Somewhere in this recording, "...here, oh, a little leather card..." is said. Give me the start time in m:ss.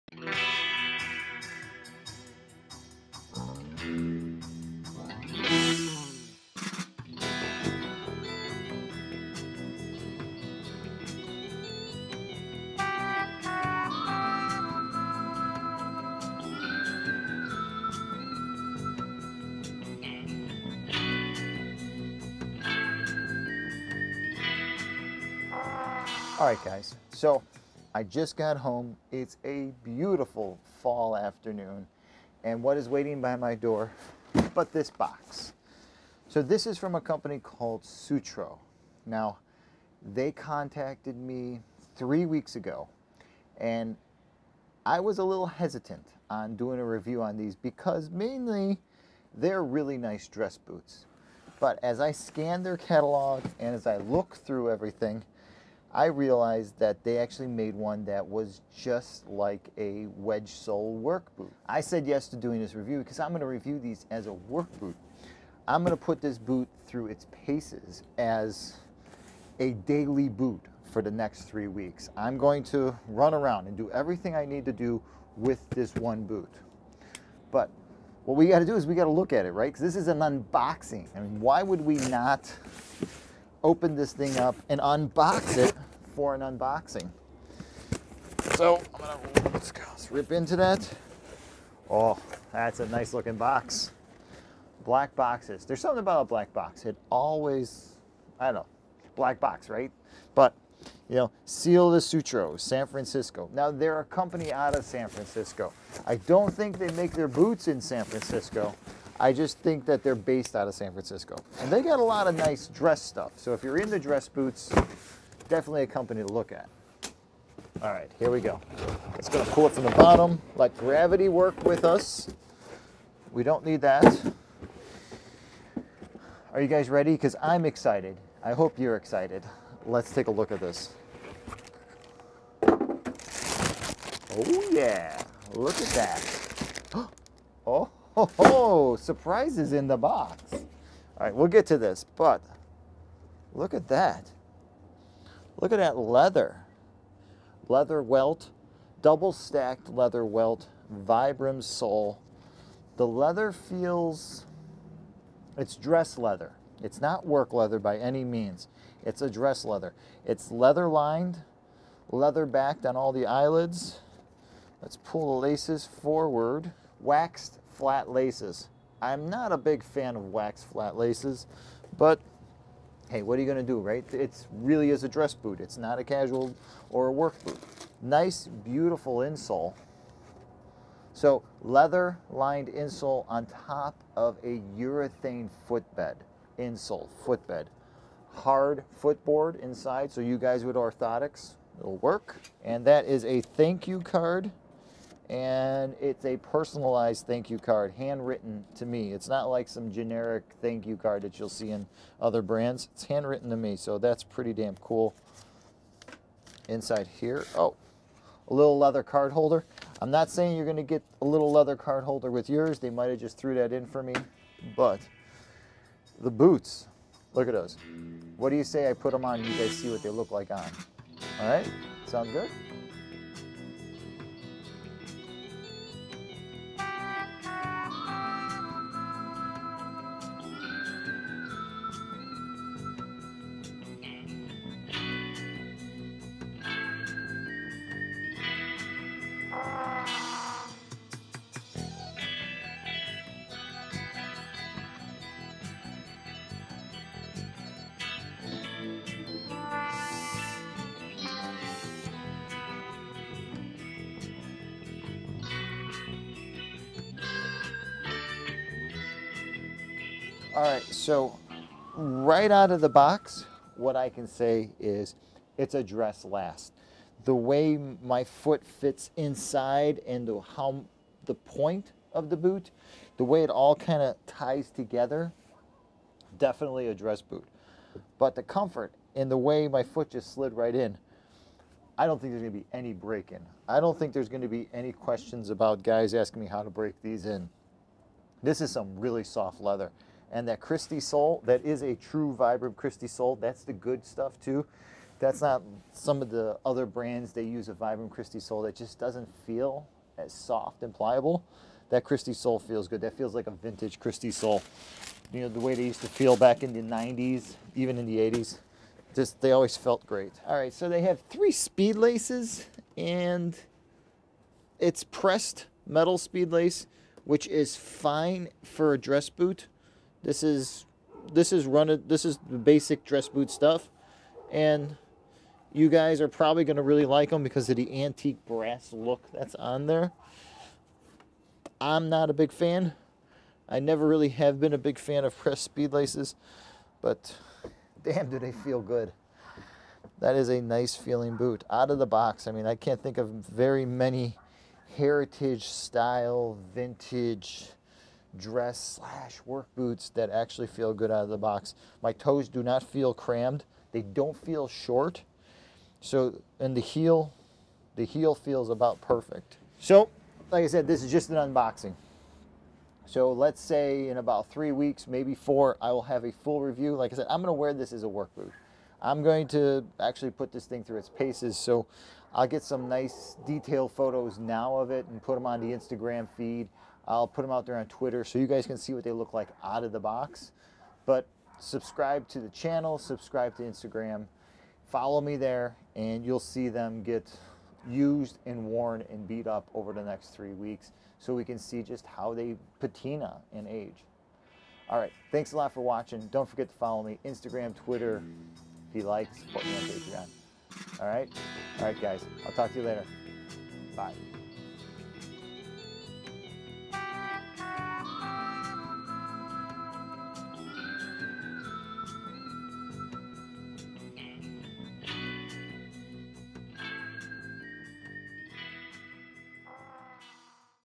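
3:27.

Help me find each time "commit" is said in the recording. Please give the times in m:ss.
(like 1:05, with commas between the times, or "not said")
not said.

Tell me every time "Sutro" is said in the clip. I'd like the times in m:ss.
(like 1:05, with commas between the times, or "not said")
0:37, 1:42.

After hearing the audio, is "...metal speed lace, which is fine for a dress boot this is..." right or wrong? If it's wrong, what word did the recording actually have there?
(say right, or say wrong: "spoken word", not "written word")
right.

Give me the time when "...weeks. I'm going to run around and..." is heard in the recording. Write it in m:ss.
1:11.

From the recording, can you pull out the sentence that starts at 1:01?
I said yes to doing this review because I'm going to review these as a work boot.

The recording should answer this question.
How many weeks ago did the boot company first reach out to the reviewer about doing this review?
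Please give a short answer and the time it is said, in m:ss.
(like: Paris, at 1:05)
3, at 0:41.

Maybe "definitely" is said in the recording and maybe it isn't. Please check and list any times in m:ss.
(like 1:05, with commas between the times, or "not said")
1:55, 4:36.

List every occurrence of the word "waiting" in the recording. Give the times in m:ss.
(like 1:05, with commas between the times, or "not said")
0:32.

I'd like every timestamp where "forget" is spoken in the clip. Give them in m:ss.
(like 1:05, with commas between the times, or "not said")
6:36.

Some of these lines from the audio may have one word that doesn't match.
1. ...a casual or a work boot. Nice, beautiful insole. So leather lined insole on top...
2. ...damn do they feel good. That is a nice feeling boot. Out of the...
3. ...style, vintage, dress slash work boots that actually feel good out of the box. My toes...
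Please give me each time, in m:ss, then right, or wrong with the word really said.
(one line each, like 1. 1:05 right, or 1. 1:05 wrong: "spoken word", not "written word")
1. 2:55 right
2. 5:38 right
3. 5:45 right.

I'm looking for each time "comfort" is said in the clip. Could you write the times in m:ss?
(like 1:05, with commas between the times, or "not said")
4:38.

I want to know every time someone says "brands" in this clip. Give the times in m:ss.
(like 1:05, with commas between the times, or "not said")
3:22, 4:56.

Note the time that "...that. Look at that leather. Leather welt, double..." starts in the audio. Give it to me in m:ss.
2:23.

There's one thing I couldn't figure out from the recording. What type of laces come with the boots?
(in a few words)
Waxed flat laces.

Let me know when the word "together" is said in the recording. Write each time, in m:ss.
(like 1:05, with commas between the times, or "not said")
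4:34.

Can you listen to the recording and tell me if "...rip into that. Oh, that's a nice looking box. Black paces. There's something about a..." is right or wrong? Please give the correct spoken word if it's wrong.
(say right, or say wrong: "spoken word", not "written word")
wrong: "boxes", not "paces".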